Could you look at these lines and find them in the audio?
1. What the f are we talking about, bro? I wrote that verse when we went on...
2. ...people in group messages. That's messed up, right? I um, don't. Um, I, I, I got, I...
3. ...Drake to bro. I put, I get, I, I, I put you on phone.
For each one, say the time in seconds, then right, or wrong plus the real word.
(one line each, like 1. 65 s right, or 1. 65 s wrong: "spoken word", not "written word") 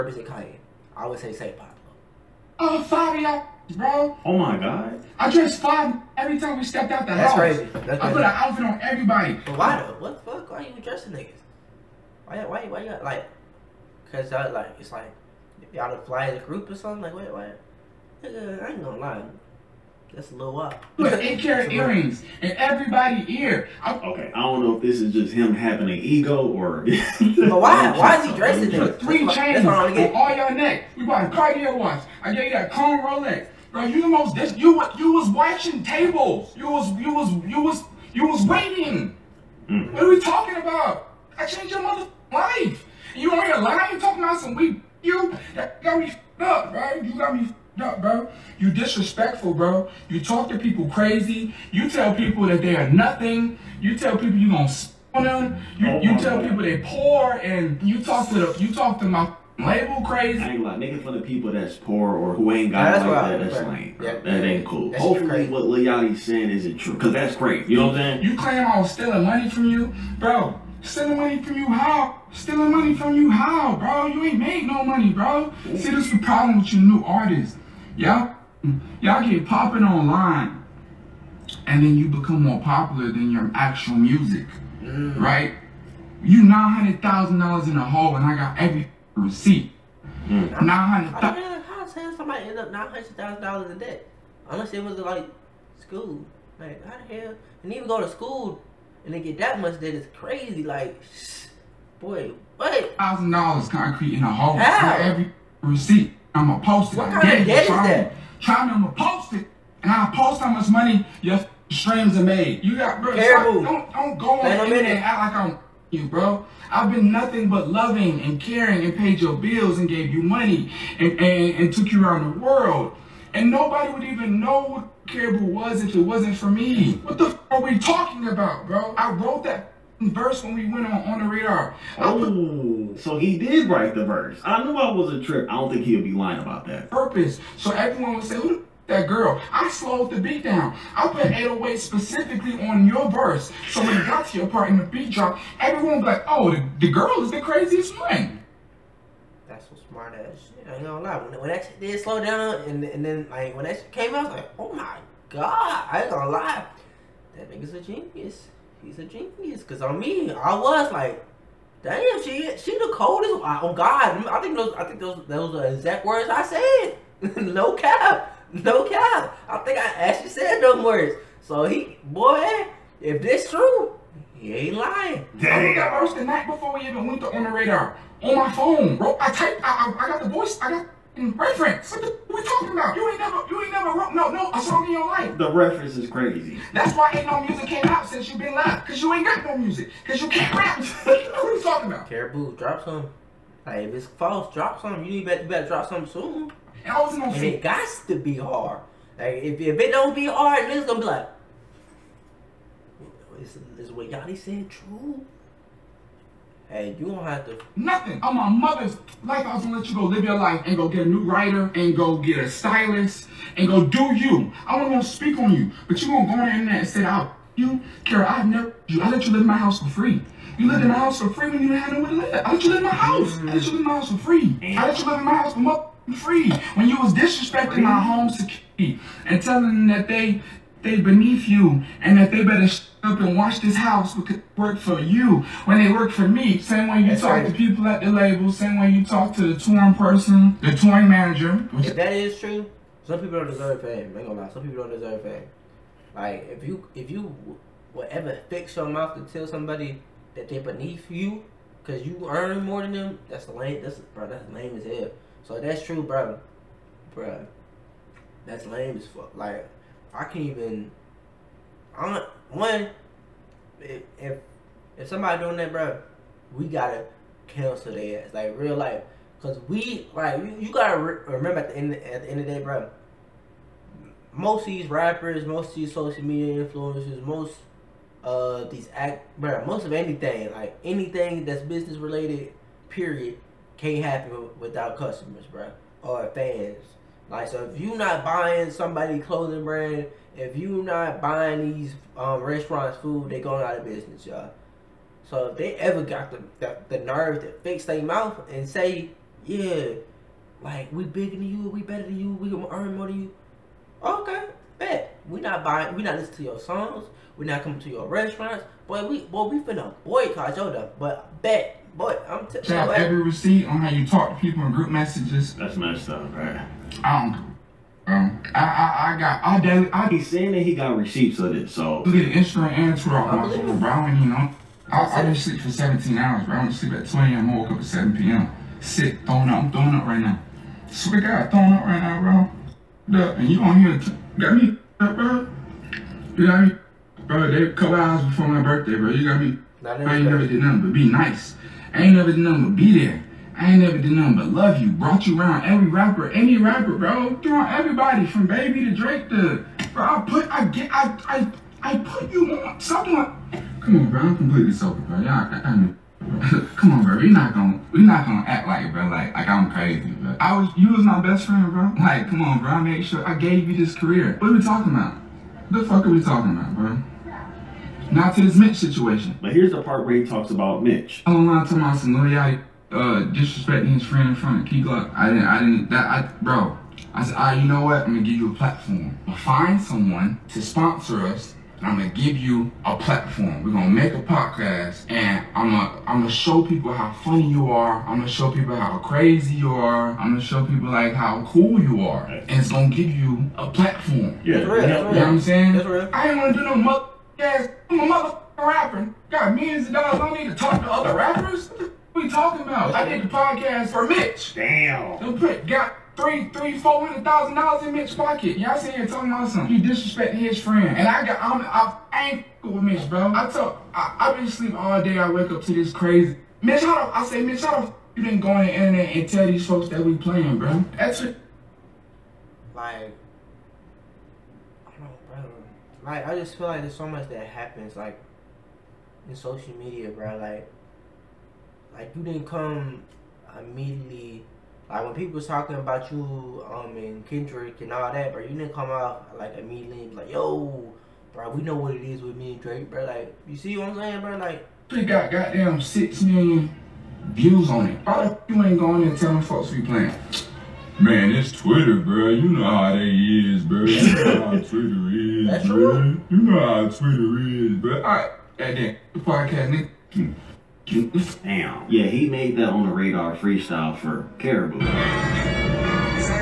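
1. 126 s right
2. 314 s right
3. 348 s wrong: "someone", not "phone".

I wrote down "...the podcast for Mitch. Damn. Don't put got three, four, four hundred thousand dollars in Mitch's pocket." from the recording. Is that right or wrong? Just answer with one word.
wrong.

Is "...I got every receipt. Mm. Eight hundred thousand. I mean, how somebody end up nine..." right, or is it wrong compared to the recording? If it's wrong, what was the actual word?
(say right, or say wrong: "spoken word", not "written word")
wrong: "Nine", not "Eight".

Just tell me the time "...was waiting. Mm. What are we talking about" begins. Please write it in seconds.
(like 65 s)
38 s.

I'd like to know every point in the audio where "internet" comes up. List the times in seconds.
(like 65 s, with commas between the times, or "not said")
216 s, 419 s.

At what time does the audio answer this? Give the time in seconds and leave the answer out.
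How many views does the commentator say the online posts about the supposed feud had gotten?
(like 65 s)
445 s.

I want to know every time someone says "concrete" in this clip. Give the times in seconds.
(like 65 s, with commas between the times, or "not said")
103 s.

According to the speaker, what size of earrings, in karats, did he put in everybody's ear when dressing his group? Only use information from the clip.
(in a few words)
8 karat.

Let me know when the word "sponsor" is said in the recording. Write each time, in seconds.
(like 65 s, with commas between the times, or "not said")
380 s.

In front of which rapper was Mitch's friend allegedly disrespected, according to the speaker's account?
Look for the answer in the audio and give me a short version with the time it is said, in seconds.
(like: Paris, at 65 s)
Key Glock, at 374 s.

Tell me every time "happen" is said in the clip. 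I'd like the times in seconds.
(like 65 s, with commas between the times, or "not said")
284 s, 427 s.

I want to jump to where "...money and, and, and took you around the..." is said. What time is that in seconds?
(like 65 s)
120 s.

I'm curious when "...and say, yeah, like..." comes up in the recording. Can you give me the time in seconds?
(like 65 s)
298 s.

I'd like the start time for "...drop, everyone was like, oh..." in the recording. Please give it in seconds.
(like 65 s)
145 s.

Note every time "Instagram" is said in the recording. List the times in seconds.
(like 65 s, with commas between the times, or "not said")
322 s.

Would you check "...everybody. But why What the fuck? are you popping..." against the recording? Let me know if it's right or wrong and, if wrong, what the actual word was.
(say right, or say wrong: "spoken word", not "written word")
wrong: "dressing", not "popping".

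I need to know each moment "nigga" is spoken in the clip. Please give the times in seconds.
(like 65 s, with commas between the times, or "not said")
11 s, 18 s, 157 s, 460 s.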